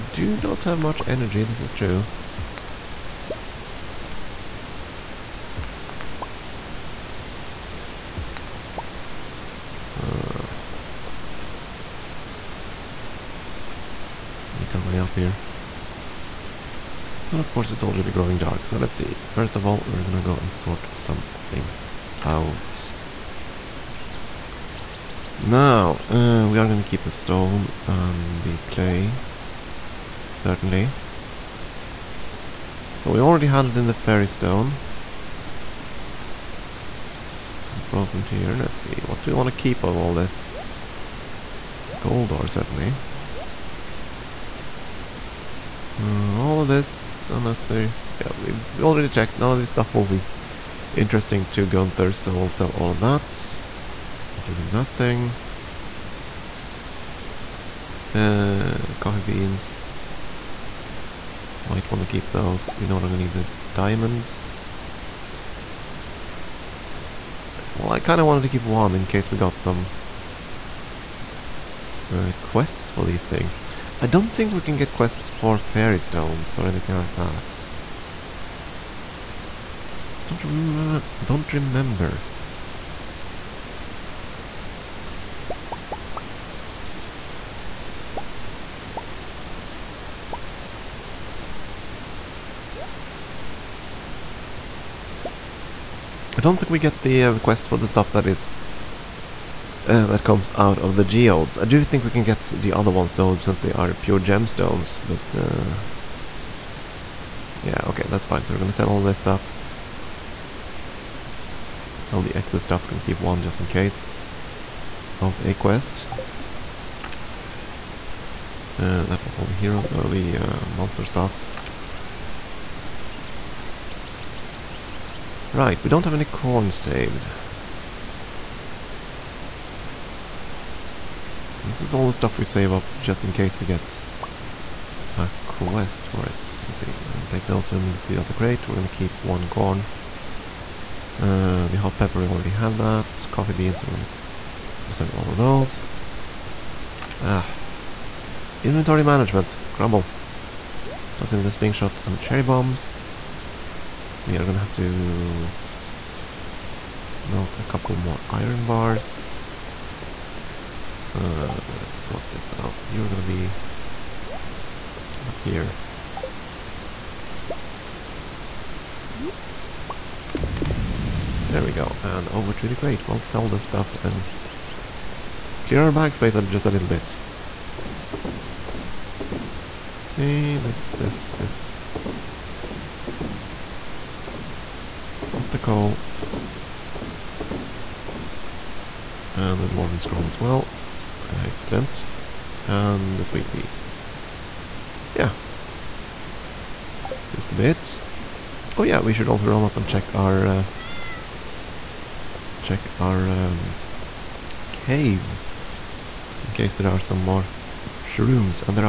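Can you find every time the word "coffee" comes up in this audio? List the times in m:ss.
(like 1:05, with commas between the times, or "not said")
0:58, 2:23.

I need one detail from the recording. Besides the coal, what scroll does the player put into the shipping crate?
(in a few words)
Dwarven Scroll.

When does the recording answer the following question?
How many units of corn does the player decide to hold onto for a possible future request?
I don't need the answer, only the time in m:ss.
2:19.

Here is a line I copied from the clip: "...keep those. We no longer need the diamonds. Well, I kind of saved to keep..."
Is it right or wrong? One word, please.
wrong.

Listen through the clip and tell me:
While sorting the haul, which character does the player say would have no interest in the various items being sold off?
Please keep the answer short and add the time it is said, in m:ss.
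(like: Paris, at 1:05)
Gunther, at 0:51.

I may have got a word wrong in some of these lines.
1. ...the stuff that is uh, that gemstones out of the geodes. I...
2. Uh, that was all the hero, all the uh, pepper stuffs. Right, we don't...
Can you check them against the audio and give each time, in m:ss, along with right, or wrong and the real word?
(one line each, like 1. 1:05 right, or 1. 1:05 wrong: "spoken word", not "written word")
1. 1:37 wrong: "comes", not "gemstones"
2. 1:58 wrong: "monster", not "pepper".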